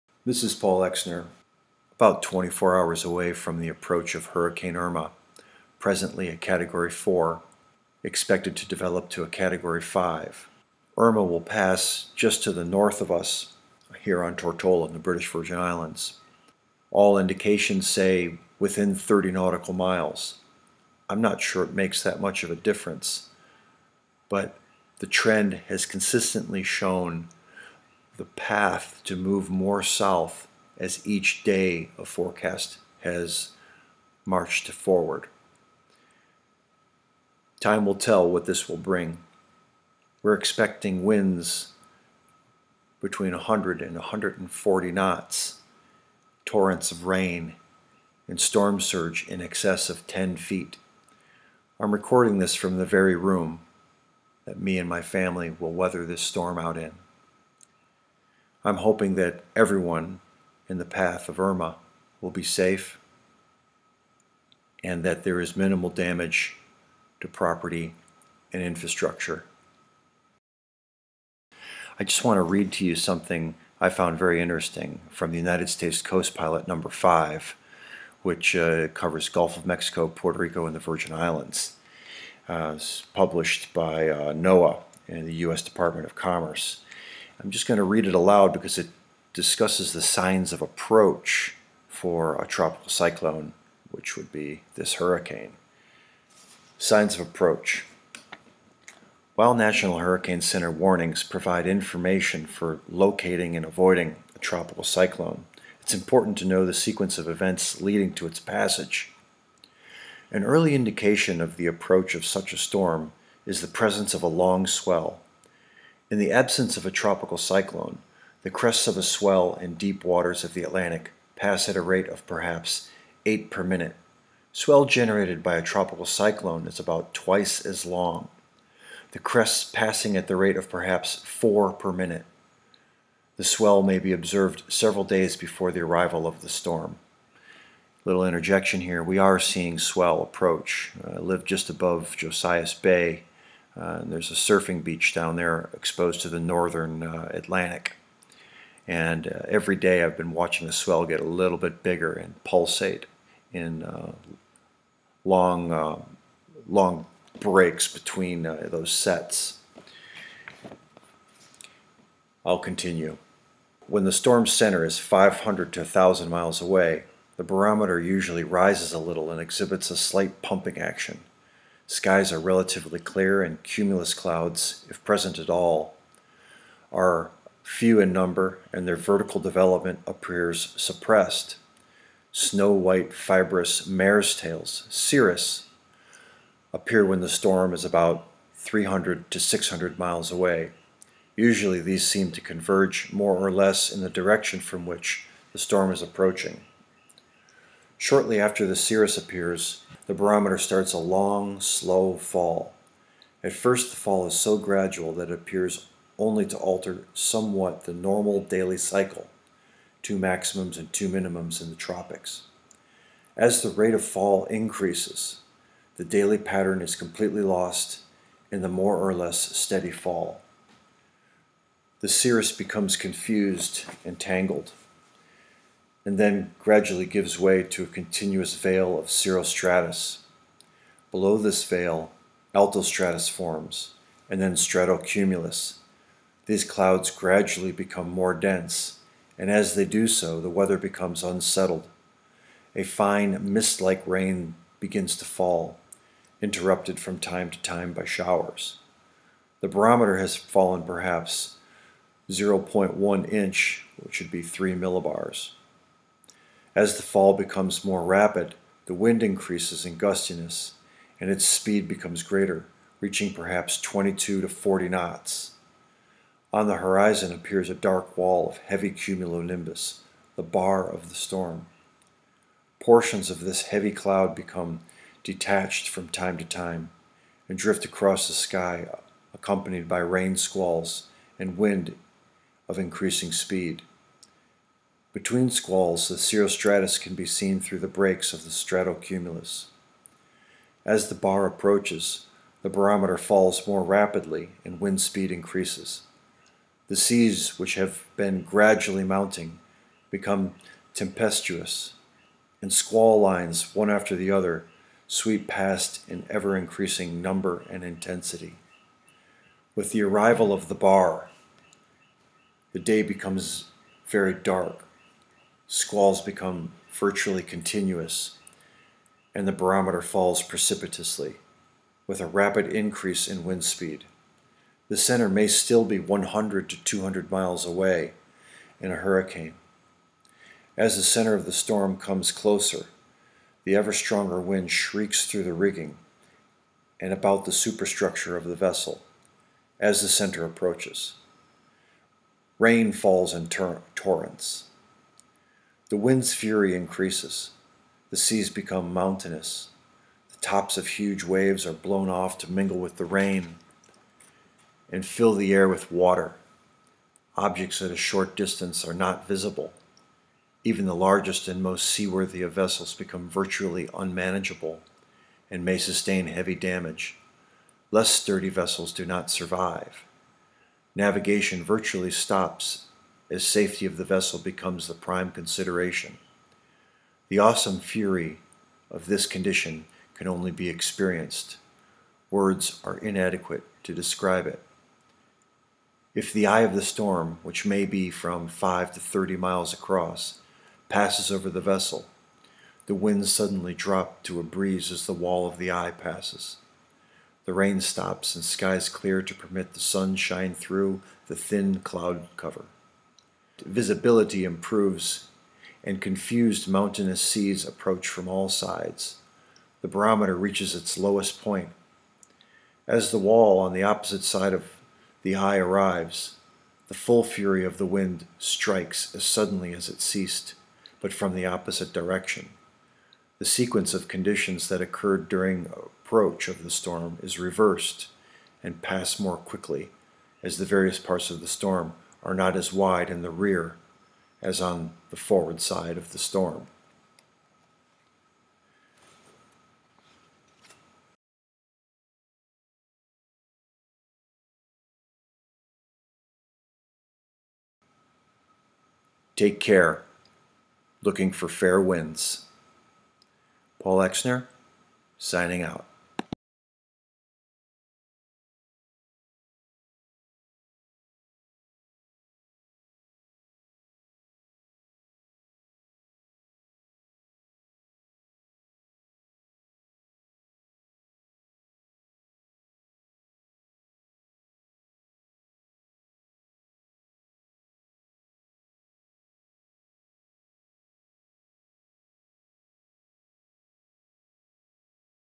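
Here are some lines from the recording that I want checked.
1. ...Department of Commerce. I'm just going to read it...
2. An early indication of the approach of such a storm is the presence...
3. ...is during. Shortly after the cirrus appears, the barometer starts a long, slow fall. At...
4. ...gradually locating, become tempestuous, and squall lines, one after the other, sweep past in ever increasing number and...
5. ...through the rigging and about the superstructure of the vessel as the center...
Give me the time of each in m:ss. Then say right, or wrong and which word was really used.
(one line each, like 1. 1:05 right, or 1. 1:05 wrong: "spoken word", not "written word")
1. 1:25 right
2. 1:50 right
3. 3:15 wrong: "approaching", not "during"
4. 4:58 wrong: "mounting", not "locating"
5. 5:35 right.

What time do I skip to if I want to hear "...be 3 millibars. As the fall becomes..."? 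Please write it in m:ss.
4:14.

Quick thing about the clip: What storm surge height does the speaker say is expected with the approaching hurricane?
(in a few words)
in excess of 10 feet.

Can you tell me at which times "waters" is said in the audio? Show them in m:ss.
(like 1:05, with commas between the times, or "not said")
2:00, 5:55.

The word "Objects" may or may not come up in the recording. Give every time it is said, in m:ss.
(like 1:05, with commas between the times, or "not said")
5:57.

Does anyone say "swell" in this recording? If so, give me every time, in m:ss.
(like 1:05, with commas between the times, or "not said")
1:54, 1:59, 2:04, 2:13, 2:19, 2:30.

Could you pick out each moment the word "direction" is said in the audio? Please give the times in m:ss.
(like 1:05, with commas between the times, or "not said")
3:14, 7:01.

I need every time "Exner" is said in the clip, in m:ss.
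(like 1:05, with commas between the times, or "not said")
0:00, 7:33.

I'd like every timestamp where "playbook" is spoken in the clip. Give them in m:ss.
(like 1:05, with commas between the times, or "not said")
not said.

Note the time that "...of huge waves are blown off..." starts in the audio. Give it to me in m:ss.
5:50.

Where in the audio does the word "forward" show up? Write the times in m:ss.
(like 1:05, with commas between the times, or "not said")
0:34, 7:15.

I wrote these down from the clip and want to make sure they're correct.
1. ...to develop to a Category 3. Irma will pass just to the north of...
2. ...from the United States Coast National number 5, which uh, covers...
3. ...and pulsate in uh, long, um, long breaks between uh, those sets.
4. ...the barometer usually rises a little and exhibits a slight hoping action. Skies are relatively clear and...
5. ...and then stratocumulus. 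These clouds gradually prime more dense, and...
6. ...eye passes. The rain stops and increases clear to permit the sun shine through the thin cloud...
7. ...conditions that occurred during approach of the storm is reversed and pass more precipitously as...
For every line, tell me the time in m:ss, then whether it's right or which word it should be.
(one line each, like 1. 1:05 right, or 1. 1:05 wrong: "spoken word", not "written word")
1. 0:08 wrong: "5", not "3"
2. 1:15 wrong: "Pilot", not "National"
3. 2:32 right
4. 2:47 wrong: "pumping", not "hoping"
5. 3:54 wrong: "become", not "prime"
6. 6:35 wrong: "skies", not "increases"
7. 7:04 wrong: "quickly", not "precipitously".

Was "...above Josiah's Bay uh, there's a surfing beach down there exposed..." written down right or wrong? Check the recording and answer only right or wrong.
right.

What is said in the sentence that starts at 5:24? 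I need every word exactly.
The center may still be 100 to 200 miles away in a hurricane.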